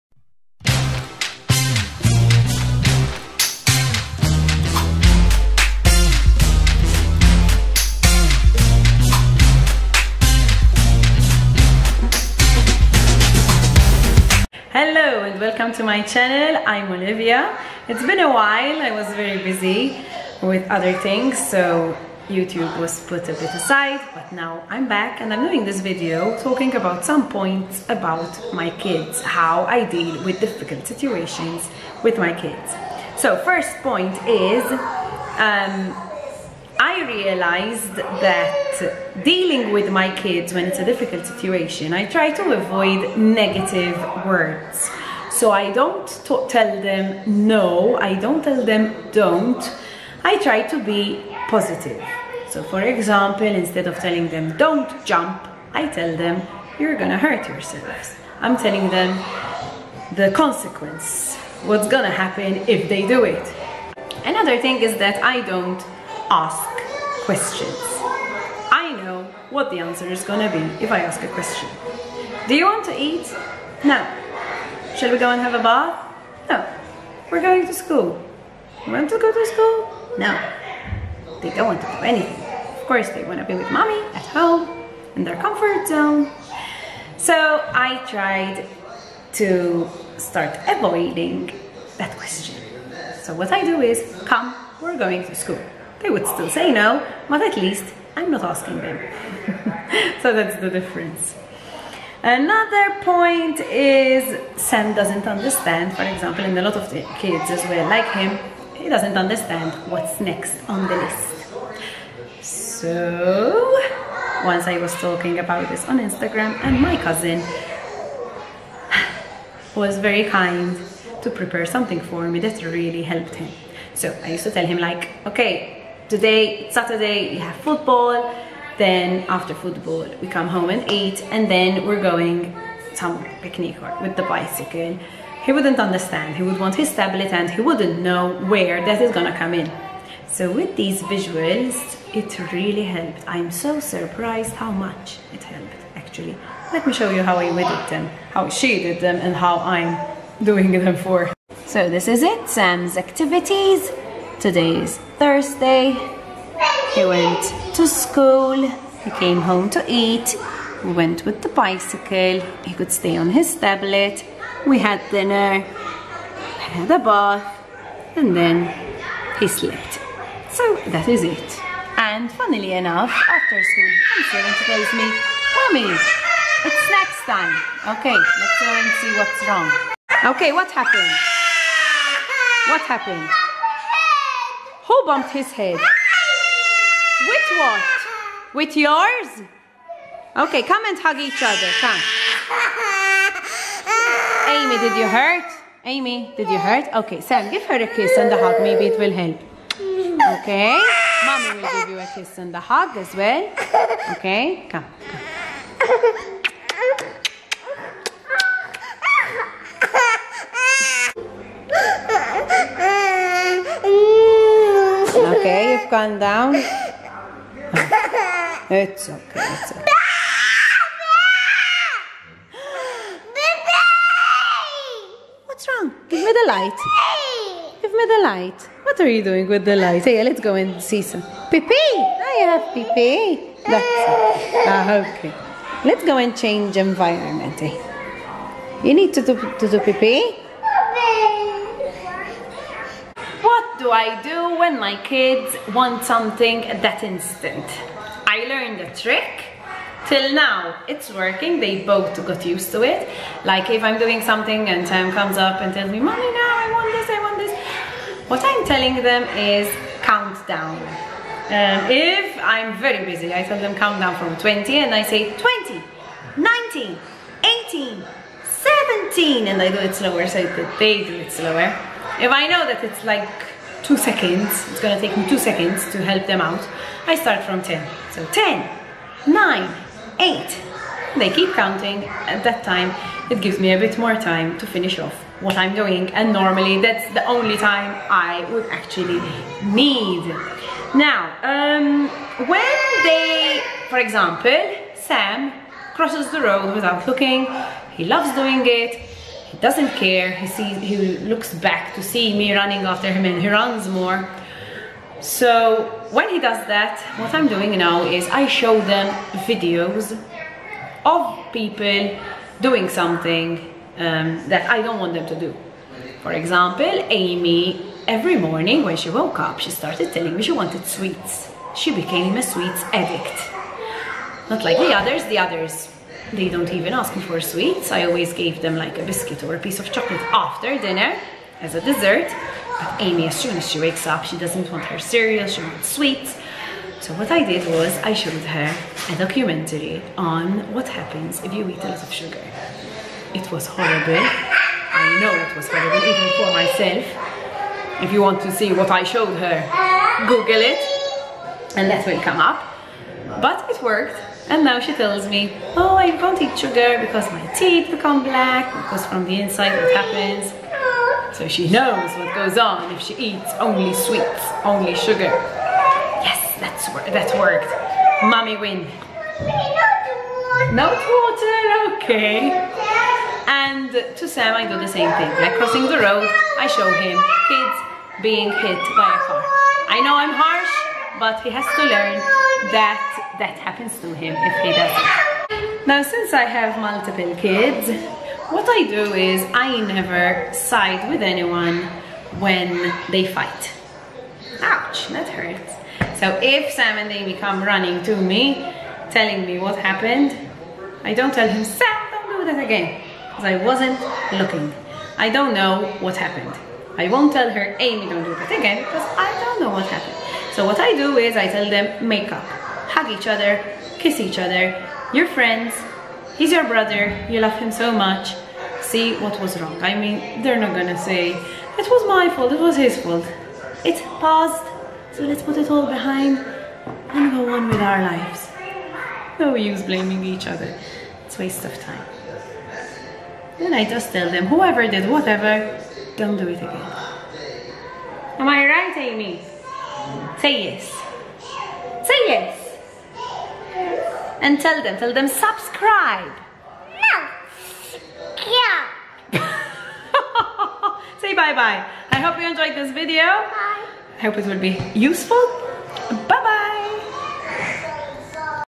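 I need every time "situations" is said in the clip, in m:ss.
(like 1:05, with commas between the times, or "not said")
0:30, 0:41.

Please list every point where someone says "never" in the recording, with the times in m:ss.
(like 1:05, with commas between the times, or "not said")
6:29.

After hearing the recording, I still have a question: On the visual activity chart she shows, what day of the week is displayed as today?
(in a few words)
Thursday.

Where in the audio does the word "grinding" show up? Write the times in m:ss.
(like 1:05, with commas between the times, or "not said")
not said.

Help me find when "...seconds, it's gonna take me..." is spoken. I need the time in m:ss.
4:33.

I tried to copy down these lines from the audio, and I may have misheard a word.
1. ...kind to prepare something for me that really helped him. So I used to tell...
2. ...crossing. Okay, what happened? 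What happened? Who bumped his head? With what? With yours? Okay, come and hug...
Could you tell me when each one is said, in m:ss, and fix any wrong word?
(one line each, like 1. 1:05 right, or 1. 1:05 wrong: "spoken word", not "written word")
1. 2:00 right
2. 2:59 wrong: "wrong", not "crossing".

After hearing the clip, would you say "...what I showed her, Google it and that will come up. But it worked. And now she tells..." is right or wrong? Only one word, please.
right.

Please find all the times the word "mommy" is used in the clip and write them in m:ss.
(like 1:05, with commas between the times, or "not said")
1:23, 2:55, 3:21, 4:15, 6:08.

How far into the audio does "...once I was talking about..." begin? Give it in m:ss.
1:54.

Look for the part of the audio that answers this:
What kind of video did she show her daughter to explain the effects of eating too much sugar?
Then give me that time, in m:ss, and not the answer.
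5:39.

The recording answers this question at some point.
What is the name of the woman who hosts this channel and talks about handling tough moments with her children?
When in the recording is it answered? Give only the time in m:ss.
0:16.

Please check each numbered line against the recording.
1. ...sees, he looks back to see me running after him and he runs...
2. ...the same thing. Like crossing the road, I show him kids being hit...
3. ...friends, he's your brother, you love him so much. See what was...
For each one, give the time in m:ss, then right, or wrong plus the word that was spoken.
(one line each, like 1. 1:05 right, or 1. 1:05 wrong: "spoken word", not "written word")
1. 5:00 right
2. 6:14 right
3. 6:55 right.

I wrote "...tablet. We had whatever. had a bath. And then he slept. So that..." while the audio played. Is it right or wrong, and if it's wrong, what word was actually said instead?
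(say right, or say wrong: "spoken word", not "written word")
wrong: "dinner", not "whatever".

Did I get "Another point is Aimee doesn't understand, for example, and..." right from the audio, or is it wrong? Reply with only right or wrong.
wrong.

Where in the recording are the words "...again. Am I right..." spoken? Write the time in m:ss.
7:16.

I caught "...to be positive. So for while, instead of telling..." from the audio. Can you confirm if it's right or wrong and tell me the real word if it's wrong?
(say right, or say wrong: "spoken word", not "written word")
wrong: "example", not "while".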